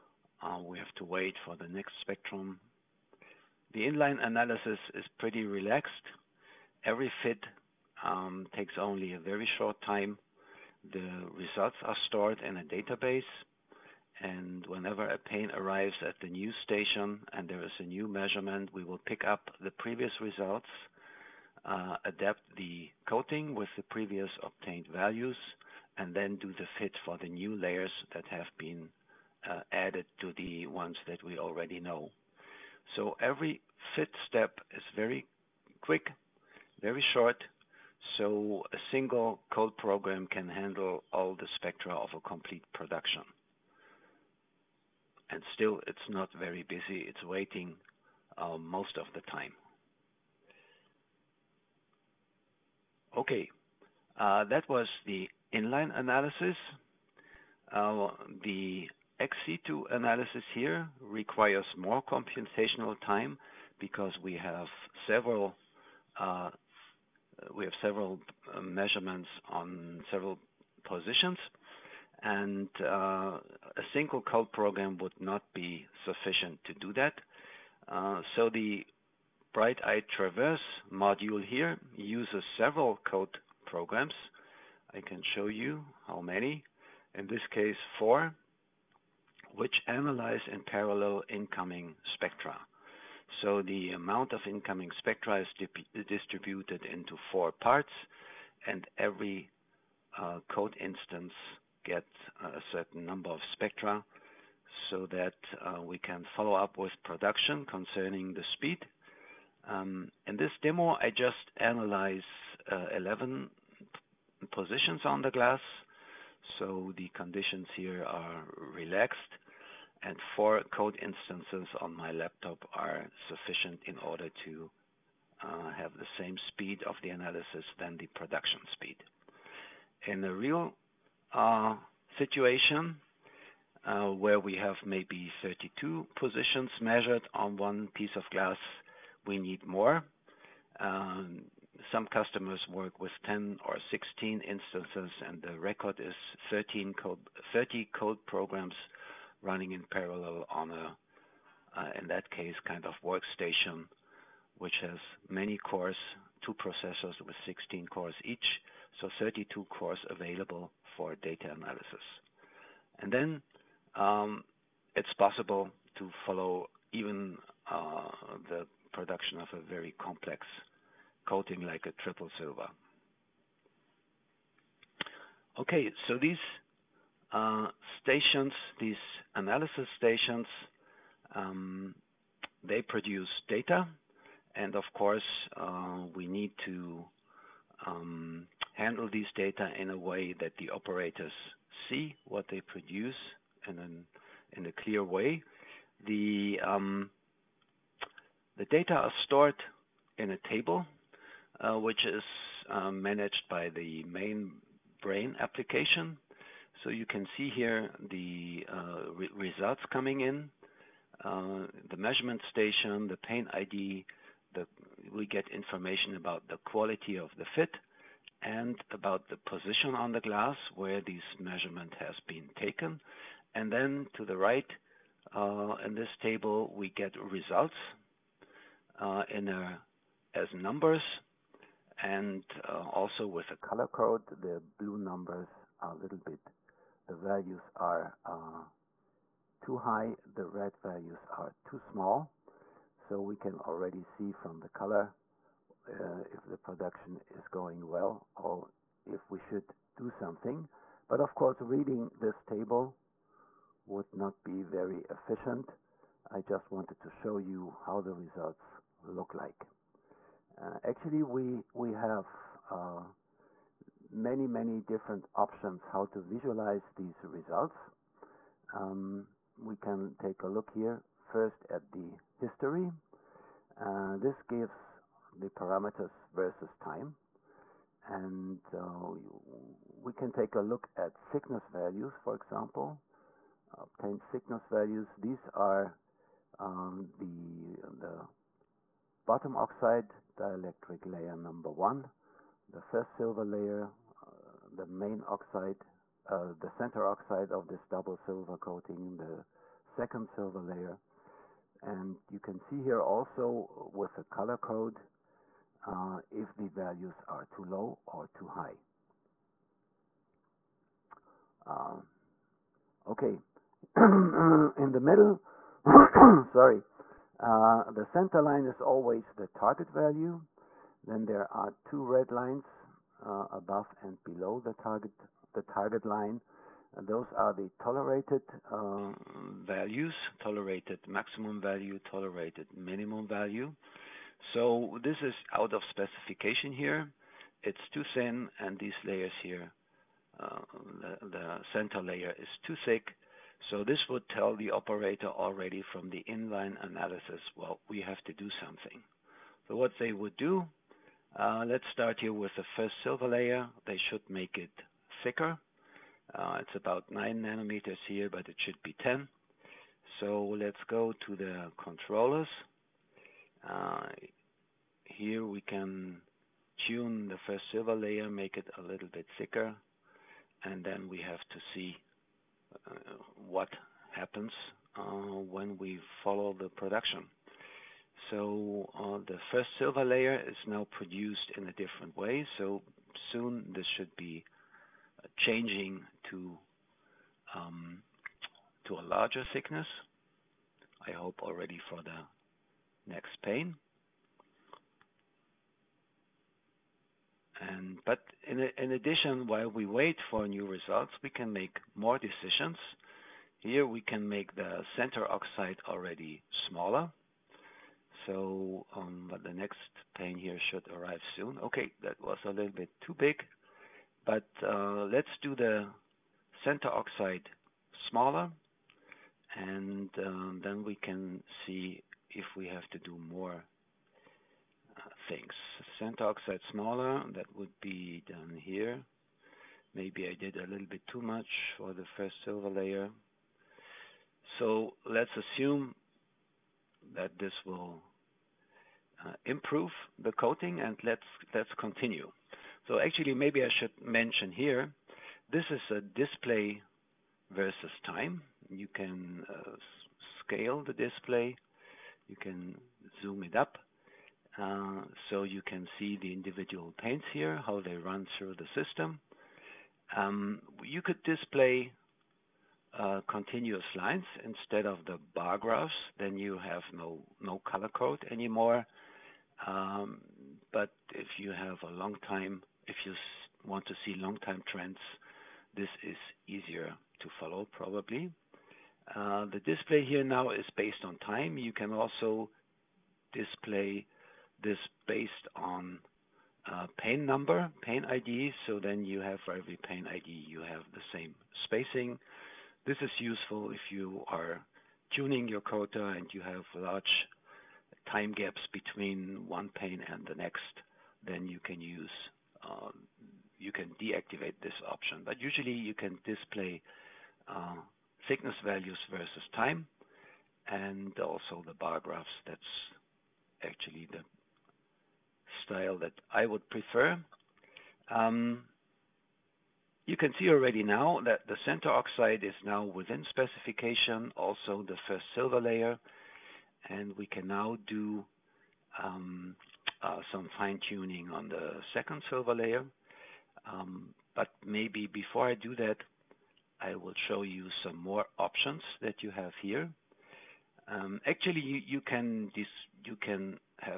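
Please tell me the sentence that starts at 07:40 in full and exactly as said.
Um, you could display uh, continuous lines instead of the bar graphs, then you have no color code anymore.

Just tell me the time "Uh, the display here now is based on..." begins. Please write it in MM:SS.
07:59.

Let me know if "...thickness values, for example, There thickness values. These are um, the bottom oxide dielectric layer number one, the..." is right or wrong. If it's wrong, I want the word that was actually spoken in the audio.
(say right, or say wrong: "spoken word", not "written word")
wrong: "Obtained", not "There".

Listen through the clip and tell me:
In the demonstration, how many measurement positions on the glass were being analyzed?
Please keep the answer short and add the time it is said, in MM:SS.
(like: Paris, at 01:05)
11, at 01:52.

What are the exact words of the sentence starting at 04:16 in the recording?
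I just wanted to show you how the results look like.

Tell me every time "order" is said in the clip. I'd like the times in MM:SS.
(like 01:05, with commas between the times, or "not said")
02:03.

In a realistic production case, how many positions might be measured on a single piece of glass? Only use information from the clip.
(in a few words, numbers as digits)
32.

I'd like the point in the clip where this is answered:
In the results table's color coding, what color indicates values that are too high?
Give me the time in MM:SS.
03:54.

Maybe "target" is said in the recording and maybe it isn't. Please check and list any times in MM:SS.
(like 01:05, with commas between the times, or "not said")
05:19, 05:24.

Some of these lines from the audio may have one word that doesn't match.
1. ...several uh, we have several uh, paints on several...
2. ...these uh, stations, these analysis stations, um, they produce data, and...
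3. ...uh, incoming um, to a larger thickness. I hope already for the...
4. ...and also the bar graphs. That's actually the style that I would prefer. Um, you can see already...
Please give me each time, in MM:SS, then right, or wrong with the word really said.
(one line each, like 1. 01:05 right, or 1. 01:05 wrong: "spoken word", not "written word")
1. 01:05 wrong: "measurements", not "paints"
2. 02:56 right
3. 06:25 wrong: "changing", not "incoming"
4. 08:30 right.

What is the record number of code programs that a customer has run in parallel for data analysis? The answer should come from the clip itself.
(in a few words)
30.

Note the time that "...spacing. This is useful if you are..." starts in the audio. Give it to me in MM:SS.
08:11.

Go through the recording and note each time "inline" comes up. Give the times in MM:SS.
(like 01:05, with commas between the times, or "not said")
00:03, 00:55, 05:46.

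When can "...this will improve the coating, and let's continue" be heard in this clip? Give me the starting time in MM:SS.
07:17.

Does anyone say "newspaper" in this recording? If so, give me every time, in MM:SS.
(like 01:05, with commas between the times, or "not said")
not said.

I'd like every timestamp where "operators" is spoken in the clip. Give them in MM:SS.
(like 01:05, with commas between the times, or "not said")
03:10, 05:44.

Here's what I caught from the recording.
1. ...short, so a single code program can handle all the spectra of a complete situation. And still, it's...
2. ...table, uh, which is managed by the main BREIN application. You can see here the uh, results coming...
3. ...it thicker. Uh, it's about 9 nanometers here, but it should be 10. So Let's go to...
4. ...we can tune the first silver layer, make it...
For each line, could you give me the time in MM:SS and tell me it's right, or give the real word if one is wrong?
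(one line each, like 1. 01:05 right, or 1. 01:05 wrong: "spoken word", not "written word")
1. 00:37 wrong: "production", not "situation"
2. 03:20 right
3. 05:54 right
4. 06:05 right.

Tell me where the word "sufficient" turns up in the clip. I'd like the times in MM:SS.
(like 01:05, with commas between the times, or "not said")
01:16, 02:03.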